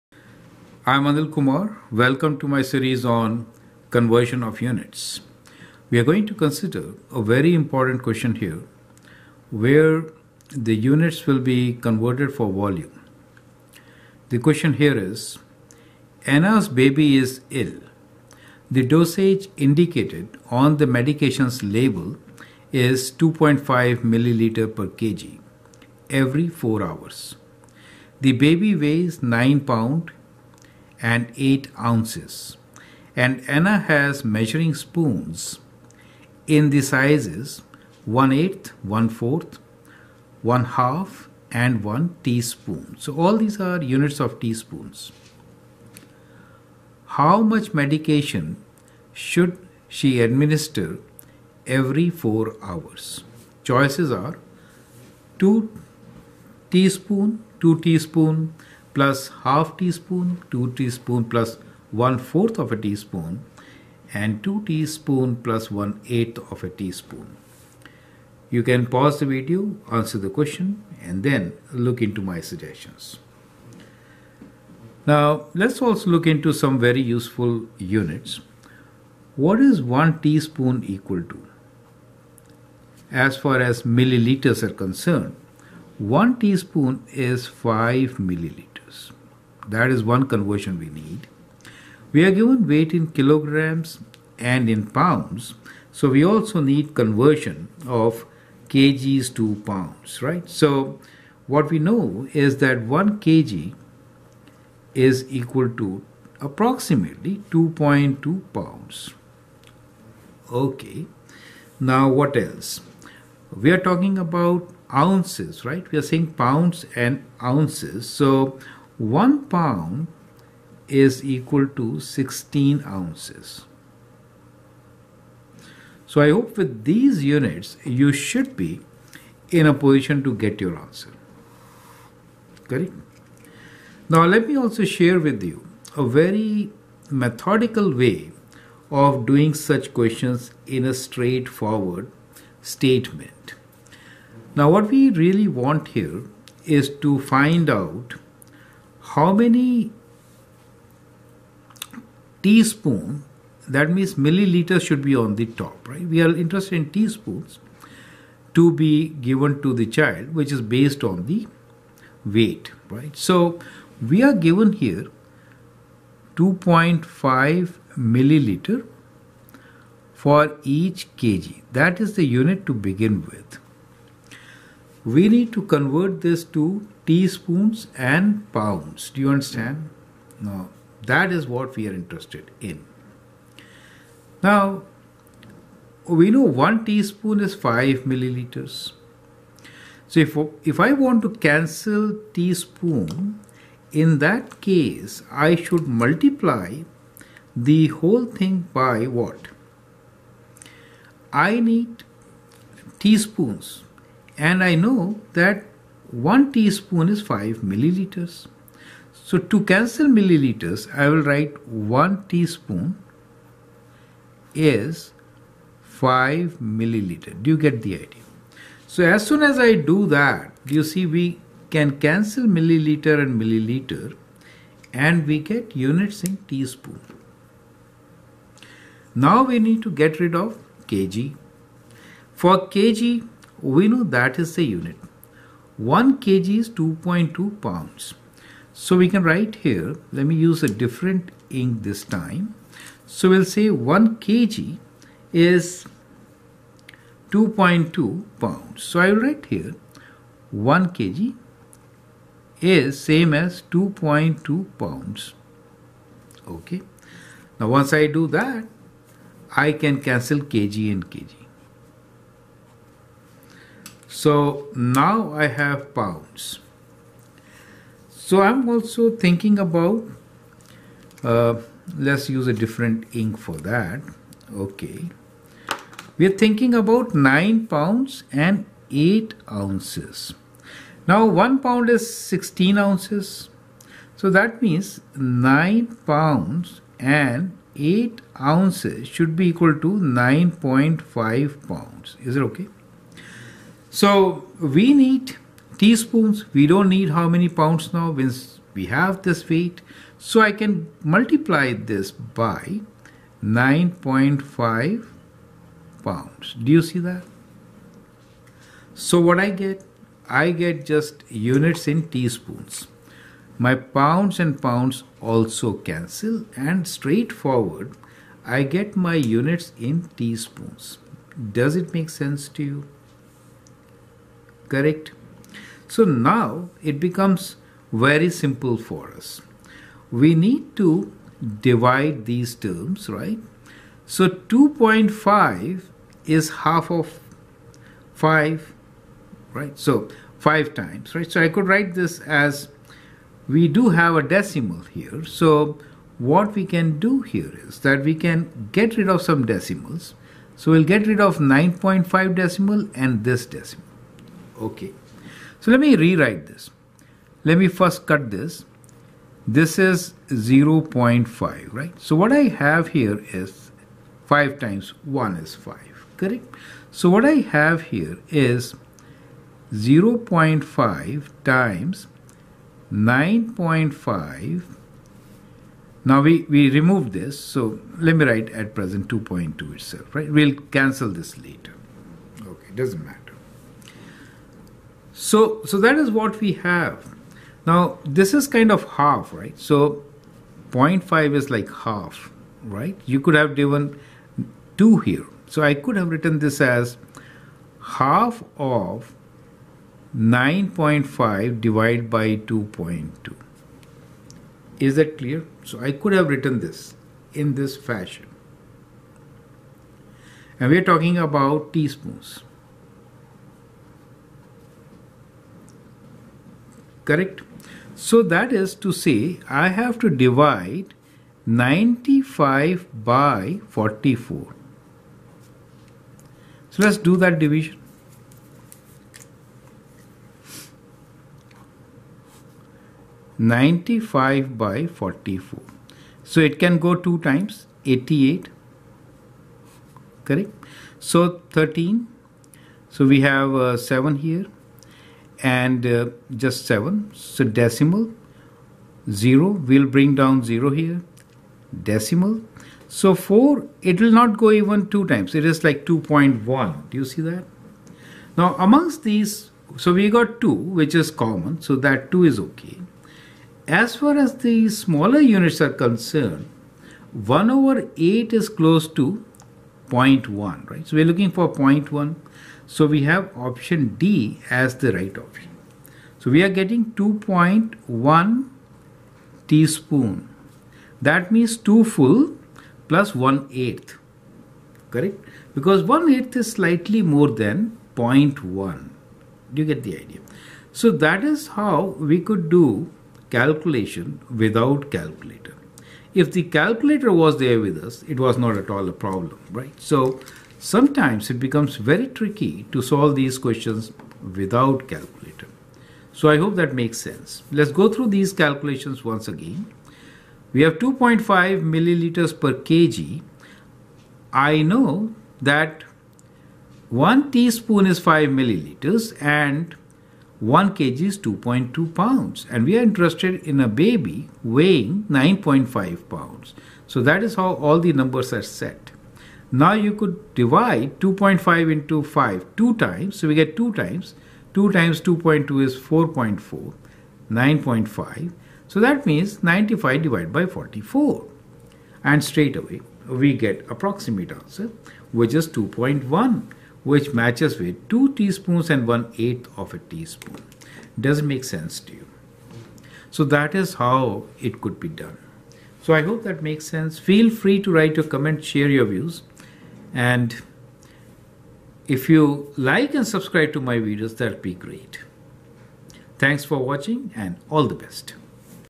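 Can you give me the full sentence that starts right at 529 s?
Now you could divide 2.5 into 5 two times, so we get two times.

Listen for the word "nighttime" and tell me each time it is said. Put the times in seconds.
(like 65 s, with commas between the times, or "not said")
not said.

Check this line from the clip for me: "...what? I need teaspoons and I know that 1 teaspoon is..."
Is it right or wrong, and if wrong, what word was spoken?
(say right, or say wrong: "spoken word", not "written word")
right.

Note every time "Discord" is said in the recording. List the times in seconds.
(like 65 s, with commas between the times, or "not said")
not said.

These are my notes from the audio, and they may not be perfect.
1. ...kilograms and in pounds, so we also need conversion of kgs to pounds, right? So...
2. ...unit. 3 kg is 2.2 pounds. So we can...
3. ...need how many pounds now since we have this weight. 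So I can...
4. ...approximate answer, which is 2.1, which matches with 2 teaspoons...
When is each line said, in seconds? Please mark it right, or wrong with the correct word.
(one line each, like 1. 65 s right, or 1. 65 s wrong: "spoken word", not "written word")
1. 93 s right
2. 234 s wrong: "1", not "3"
3. 296 s right
4. 543 s right.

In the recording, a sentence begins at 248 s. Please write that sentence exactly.
So I will write here 1 kg is same as 2.2 pounds.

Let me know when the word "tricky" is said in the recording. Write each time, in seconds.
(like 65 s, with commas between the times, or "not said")
502 s.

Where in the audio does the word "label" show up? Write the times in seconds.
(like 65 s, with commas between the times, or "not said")
21 s.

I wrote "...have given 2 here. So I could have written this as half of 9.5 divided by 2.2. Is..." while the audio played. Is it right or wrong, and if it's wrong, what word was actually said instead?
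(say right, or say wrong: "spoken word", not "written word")
right.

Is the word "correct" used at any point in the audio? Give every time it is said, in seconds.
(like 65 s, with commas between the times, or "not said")
132 s, 324 s, 366 s, 417 s, 440 s, 484 s.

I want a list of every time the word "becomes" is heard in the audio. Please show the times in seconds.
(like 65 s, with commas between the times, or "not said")
326 s, 501 s.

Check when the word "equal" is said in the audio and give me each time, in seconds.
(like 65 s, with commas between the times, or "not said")
80 s, 105 s, 121 s, 289 s.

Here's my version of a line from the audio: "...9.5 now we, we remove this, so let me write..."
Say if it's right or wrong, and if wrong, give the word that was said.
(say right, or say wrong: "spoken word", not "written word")
right.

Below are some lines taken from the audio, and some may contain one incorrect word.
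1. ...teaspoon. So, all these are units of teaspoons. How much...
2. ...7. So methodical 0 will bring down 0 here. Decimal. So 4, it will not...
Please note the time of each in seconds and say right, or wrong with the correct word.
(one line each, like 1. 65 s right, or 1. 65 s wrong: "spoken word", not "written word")
1. 42 s right
2. 446 s wrong: "decimal", not "methodical".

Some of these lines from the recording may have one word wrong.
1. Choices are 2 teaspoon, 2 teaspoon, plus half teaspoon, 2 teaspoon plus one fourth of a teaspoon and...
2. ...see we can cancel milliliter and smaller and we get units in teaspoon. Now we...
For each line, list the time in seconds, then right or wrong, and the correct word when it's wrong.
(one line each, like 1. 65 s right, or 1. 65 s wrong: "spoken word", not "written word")
1. 53 s right
2. 220 s wrong: "milliliter", not "smaller".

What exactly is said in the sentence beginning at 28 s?
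The baby weighs 9 pound and 8 ounces.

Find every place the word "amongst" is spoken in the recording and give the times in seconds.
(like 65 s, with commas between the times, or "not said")
458 s.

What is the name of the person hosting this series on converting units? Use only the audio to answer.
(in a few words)
Anil Kumar.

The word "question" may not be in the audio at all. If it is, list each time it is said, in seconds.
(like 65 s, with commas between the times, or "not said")
8 s, 14 s, 70 s, 139 s, 503 s.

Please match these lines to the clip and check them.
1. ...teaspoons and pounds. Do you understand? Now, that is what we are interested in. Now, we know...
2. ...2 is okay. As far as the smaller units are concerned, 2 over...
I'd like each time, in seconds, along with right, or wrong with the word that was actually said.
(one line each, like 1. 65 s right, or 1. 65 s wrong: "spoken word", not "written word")
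1. 177 s right
2. 462 s wrong: "1", not "2".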